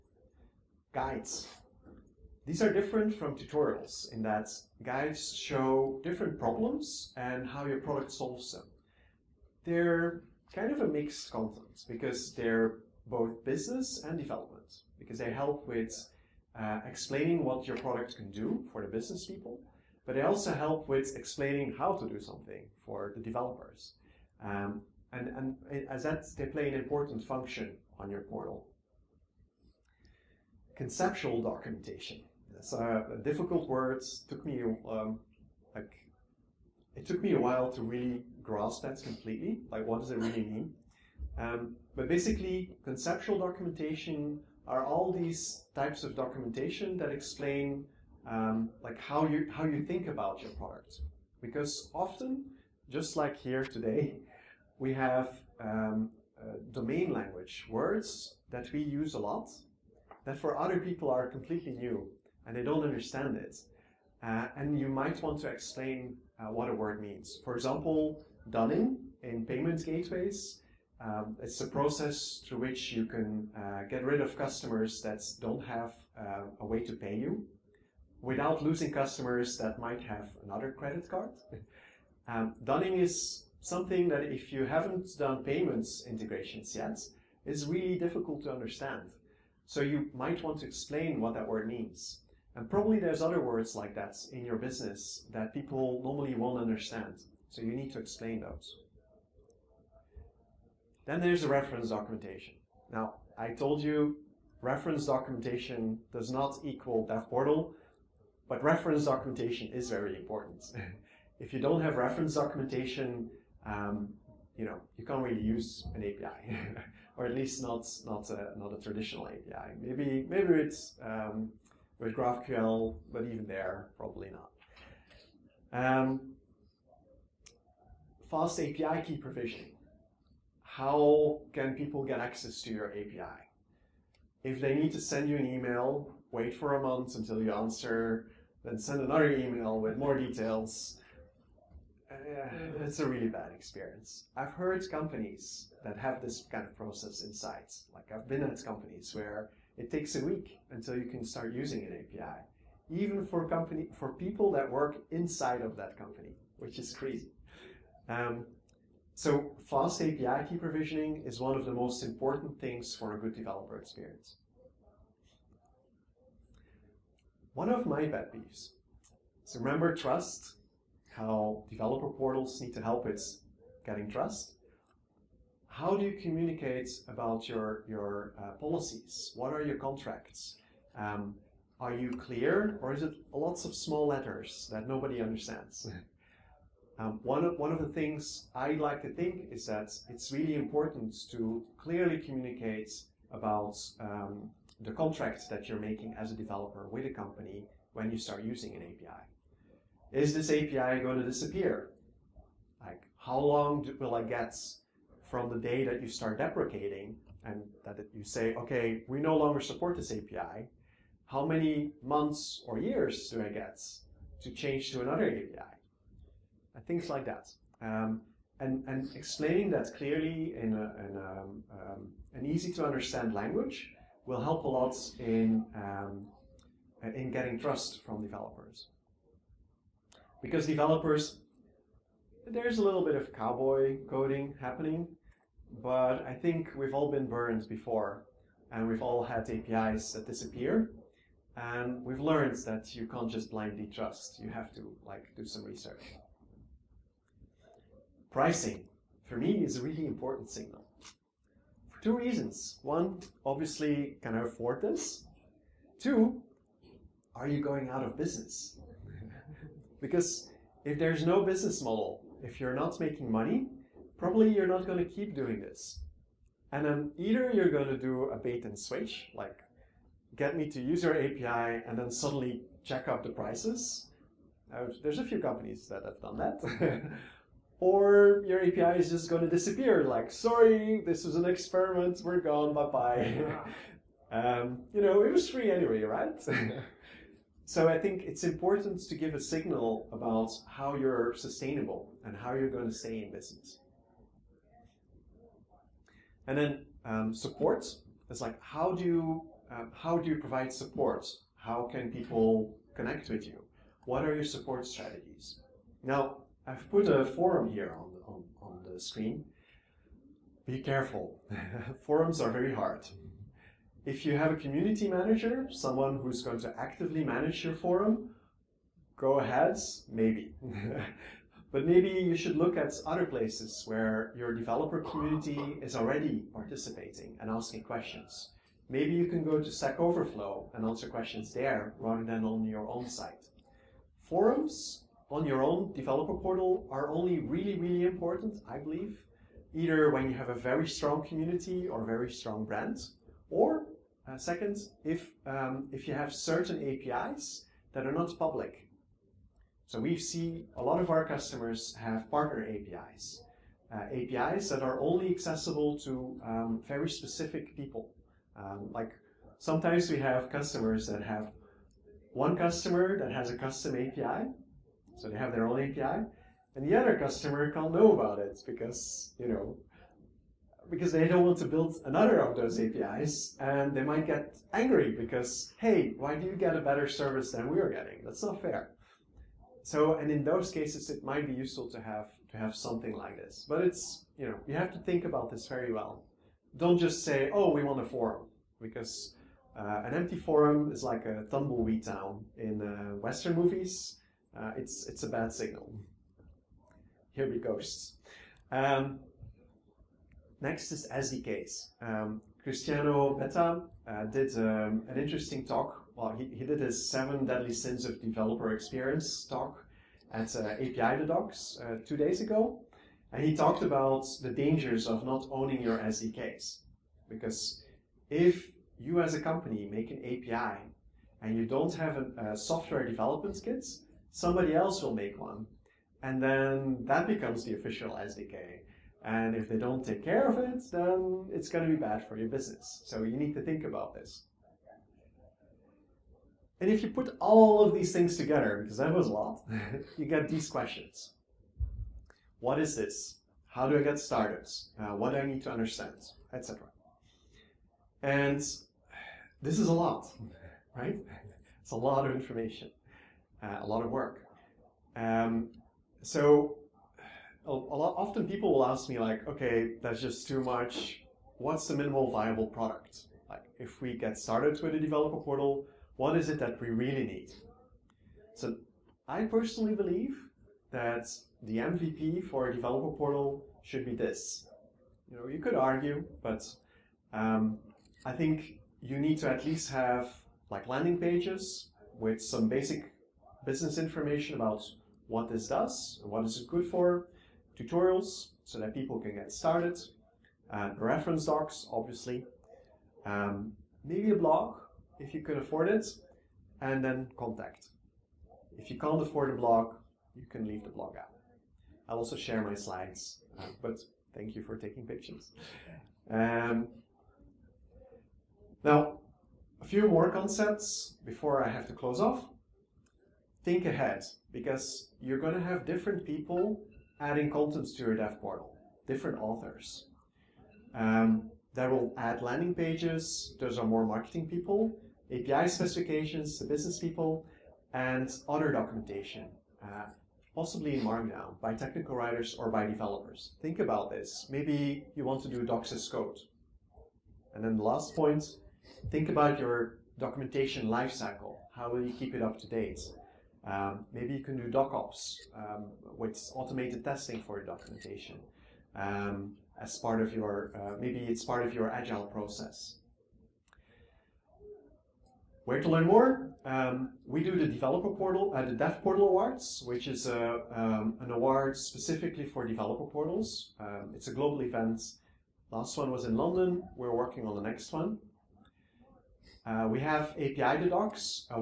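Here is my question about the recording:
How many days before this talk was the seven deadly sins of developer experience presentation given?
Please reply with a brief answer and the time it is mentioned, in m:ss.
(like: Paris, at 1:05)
2 days, at 6:52.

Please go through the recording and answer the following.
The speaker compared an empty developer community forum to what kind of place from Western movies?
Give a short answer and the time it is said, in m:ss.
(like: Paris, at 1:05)
A tumbleweed town, at 6:31.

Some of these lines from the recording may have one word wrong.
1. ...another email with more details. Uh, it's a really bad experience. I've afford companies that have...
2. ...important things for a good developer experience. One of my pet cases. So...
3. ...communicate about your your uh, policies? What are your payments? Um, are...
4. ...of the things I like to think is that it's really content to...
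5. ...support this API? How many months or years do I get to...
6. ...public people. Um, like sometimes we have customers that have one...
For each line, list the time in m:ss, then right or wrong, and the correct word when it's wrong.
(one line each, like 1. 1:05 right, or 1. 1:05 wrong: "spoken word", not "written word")
1. 2:19 wrong: "heard", not "afford"
2. 2:42 wrong: "peeves", not "cases"
3. 2:56 wrong: "contracts", not "payments"
4. 3:07 wrong: "important", not "content"
5. 3:29 right
6. 5:57 wrong: "specific", not "public".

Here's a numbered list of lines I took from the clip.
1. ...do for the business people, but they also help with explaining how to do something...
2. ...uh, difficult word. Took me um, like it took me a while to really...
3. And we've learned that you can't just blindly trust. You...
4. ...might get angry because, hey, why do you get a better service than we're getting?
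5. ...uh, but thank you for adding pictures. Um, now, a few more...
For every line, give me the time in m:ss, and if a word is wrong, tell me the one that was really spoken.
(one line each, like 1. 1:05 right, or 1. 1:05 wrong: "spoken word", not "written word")
1. 0:18 right
2. 0:33 right
3. 4:01 right
4. 6:14 right
5. 8:23 wrong: "taking", not "adding".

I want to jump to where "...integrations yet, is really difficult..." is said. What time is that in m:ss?
1:26.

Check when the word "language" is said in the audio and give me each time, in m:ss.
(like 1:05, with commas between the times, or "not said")
0:57, 3:43.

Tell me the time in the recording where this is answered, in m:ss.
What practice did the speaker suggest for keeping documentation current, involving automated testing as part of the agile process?
9:04.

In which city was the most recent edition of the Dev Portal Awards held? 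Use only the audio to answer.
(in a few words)
London.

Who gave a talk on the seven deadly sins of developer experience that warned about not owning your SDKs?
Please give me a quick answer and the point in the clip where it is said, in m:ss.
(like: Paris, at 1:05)
Cristiano Betta, at 6:42.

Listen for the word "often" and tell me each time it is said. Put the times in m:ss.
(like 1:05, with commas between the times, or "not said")
0:51, 7:38.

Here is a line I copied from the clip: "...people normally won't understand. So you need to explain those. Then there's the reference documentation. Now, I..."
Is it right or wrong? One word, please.
right.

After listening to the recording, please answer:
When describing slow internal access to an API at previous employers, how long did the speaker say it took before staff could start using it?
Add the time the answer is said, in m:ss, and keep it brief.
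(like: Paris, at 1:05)
A week, at 2:30.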